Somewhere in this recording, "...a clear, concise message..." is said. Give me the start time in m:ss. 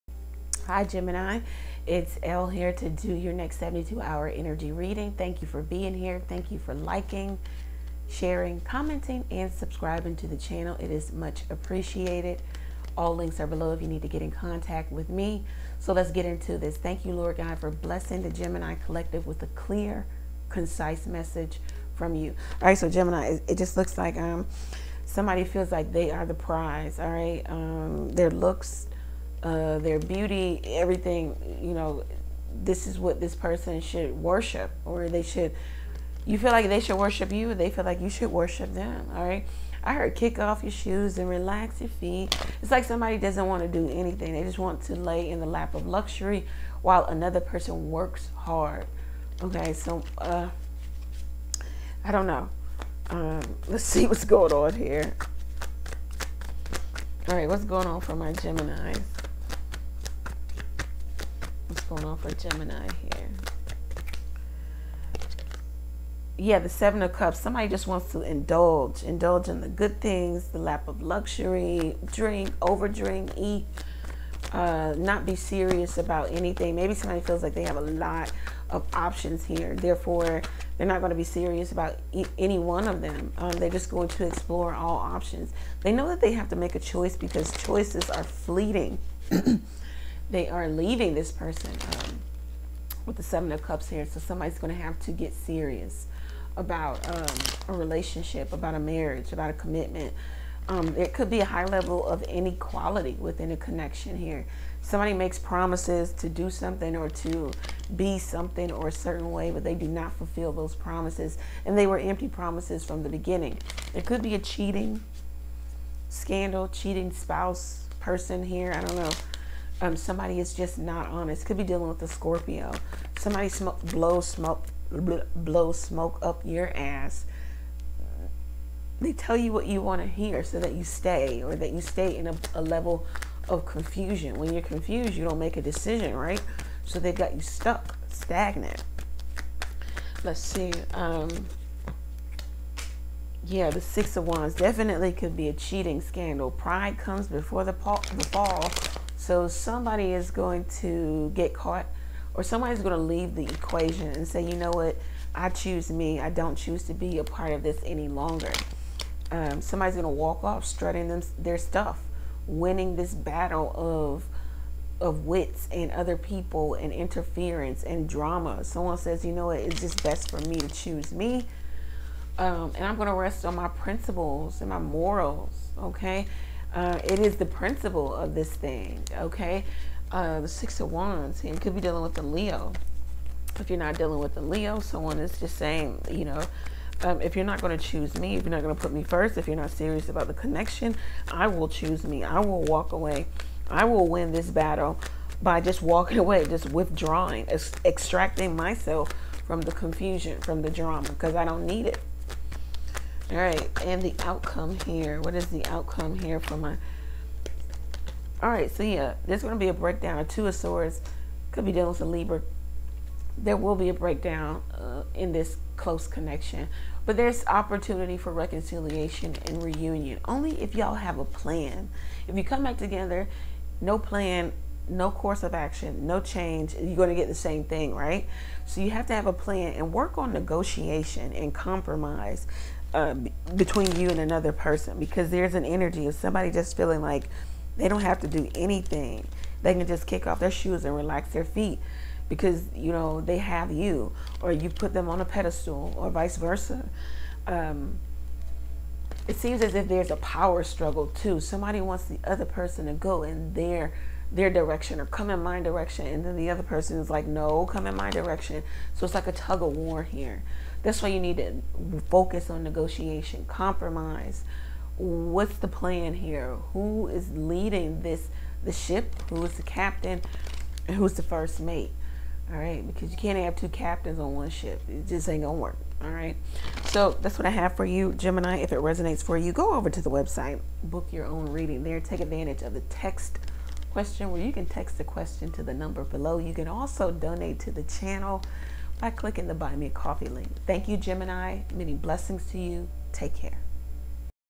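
0:19.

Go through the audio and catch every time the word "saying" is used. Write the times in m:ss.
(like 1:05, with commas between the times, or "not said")
3:05.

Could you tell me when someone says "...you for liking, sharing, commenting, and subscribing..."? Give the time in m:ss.
0:06.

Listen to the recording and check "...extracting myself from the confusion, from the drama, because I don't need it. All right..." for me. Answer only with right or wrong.
right.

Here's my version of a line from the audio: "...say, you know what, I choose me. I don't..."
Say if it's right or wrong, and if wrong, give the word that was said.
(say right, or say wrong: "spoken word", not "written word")
right.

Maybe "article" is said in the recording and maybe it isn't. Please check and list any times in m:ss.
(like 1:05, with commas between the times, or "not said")
not said.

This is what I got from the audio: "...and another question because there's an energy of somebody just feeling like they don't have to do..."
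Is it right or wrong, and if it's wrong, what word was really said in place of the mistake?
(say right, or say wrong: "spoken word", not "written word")
wrong: "person", not "question".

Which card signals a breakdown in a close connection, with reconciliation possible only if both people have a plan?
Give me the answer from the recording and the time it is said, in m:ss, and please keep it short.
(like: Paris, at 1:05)
Two of Swords, at 3:30.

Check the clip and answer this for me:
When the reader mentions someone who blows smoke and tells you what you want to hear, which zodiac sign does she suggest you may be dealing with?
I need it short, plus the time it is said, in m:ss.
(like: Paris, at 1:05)
Scorpio, at 2:02.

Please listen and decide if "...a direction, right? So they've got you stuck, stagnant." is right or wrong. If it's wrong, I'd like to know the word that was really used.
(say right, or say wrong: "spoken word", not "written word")
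wrong: "decision", not "direction".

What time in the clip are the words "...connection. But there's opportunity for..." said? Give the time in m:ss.
3:36.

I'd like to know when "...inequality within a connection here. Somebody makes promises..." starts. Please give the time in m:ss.
1:42.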